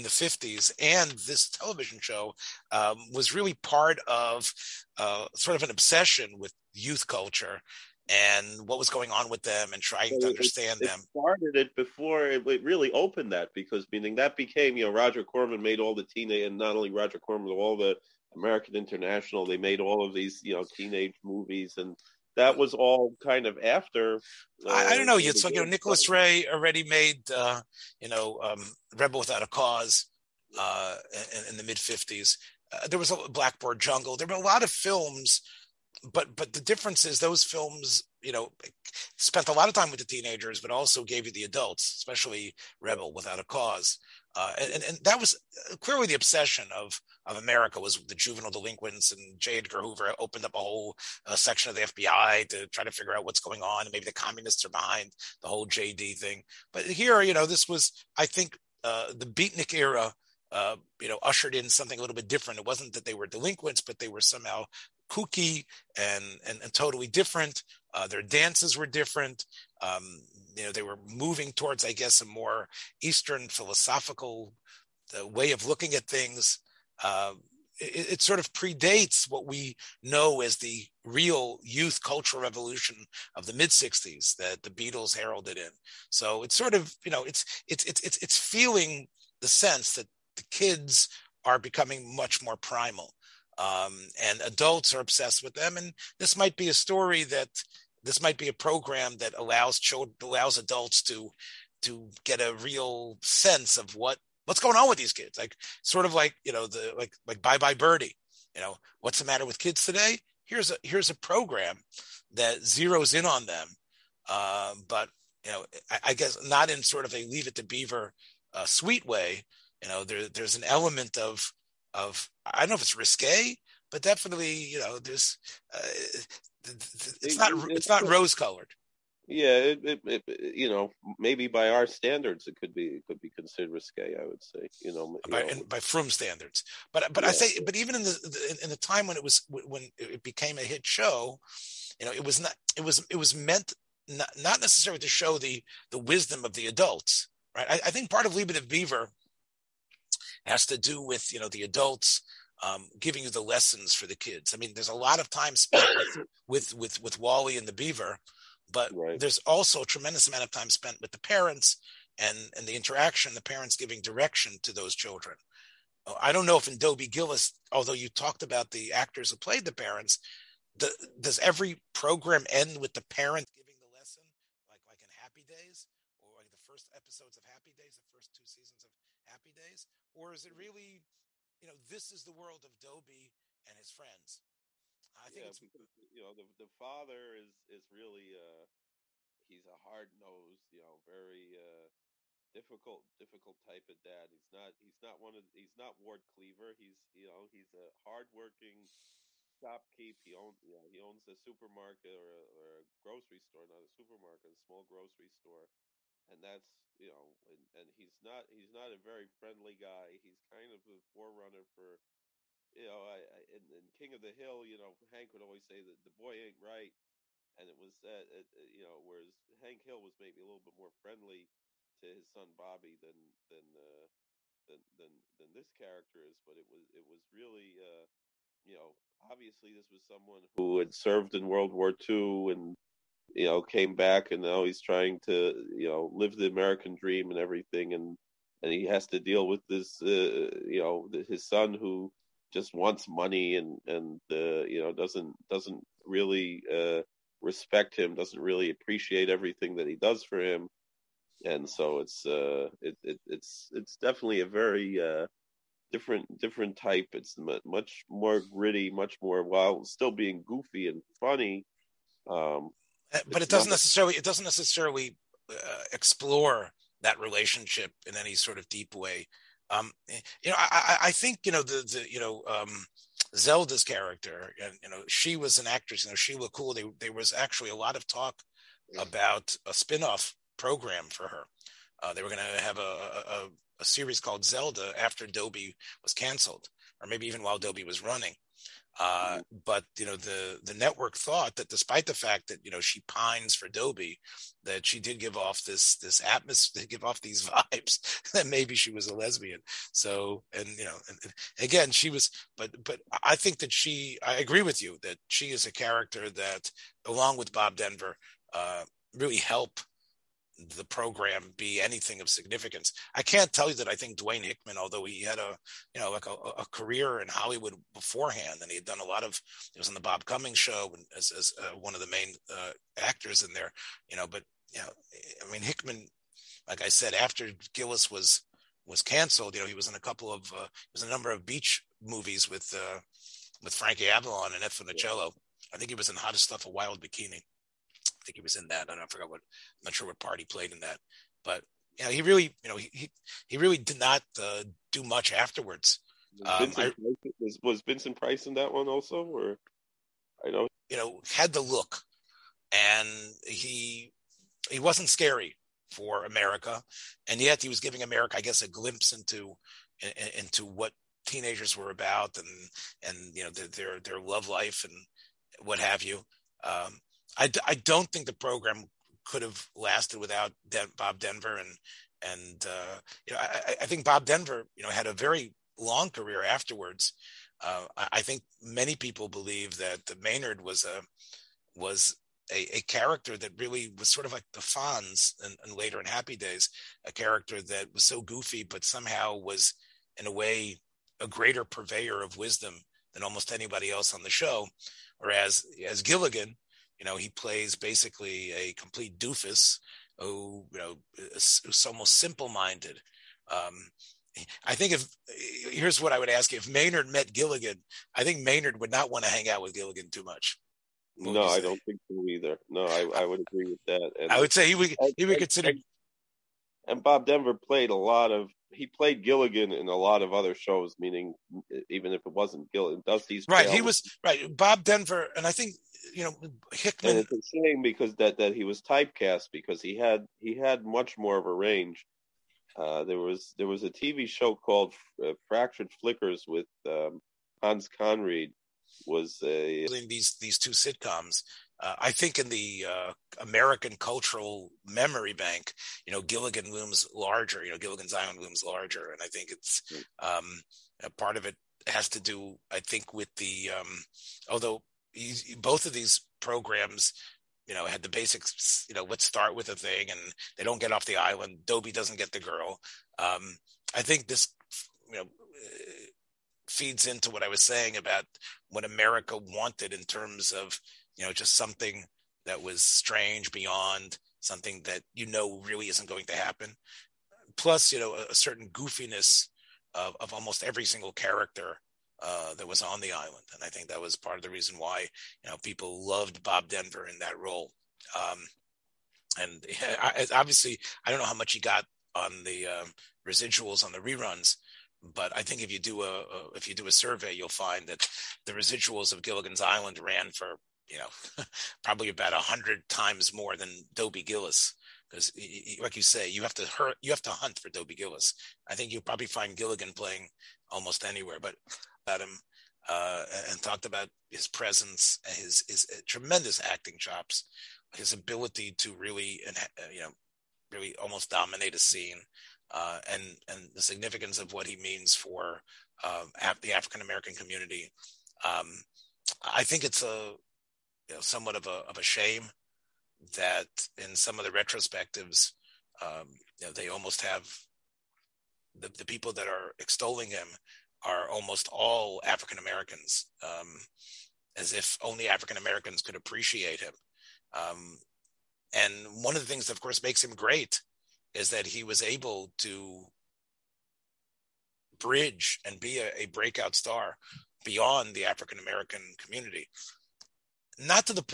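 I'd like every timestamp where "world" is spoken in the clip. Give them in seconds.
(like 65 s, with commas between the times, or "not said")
182 s, 231 s.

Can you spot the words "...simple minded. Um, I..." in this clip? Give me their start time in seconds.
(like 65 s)
402 s.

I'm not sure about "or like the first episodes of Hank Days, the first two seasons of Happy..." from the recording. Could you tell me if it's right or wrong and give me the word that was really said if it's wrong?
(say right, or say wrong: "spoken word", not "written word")
wrong: "Happy", not "Hank".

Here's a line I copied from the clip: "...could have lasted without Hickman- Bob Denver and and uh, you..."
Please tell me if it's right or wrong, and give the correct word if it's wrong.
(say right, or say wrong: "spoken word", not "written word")
wrong: "Den", not "Hickman".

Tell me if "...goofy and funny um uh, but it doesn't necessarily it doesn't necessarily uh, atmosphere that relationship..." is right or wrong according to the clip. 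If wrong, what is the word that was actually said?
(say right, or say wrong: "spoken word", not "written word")
wrong: "explore", not "atmosphere".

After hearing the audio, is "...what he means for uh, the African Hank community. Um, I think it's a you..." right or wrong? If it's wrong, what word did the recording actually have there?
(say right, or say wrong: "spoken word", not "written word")
wrong: "American", not "Hank".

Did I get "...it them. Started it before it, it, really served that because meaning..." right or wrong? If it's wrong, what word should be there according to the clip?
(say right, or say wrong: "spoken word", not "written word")
wrong: "opened", not "served".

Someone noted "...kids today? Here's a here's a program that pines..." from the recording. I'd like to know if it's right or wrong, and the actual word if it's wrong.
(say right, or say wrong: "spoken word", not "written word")
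wrong: "zeroes", not "pines".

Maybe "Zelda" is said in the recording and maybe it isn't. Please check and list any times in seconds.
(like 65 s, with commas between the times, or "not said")
273 s, 284 s.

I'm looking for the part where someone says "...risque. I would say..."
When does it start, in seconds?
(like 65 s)
133 s.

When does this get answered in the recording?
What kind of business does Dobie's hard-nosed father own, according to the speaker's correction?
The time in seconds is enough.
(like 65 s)
204 s.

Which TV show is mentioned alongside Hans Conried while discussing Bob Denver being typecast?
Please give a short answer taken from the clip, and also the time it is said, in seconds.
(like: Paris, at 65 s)
Fractured Flickers, at 435 s.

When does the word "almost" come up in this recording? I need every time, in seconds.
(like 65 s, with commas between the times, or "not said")
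393 s, 401 s, 480 s, 510 s, 521 s, 536 s, 541 s.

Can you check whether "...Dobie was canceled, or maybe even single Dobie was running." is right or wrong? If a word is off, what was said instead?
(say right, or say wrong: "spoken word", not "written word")
wrong: "while", not "single".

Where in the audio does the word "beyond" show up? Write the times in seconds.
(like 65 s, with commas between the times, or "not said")
473 s, 557 s.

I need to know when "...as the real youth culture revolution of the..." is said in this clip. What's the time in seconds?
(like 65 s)
80 s.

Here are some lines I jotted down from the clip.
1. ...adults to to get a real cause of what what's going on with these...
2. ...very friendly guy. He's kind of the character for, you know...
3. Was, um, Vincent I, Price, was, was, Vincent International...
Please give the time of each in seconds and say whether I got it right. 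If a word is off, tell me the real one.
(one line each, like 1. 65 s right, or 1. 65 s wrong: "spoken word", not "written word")
1. 100 s wrong: "sense", not "cause"
2. 208 s wrong: "forerunner", not "character"
3. 346 s wrong: "Price", not "International".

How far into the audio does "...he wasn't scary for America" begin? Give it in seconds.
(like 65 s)
354 s.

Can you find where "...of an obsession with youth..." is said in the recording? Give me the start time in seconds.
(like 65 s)
5 s.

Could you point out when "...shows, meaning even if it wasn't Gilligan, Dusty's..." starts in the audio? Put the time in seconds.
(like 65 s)
420 s.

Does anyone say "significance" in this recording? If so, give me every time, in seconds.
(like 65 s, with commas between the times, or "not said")
312 s, 523 s.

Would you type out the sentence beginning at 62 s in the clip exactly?
It wasn't that they were delinquents, but they were somehow kooky and, and, and totally different.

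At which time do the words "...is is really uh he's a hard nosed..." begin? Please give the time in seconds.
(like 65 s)
187 s.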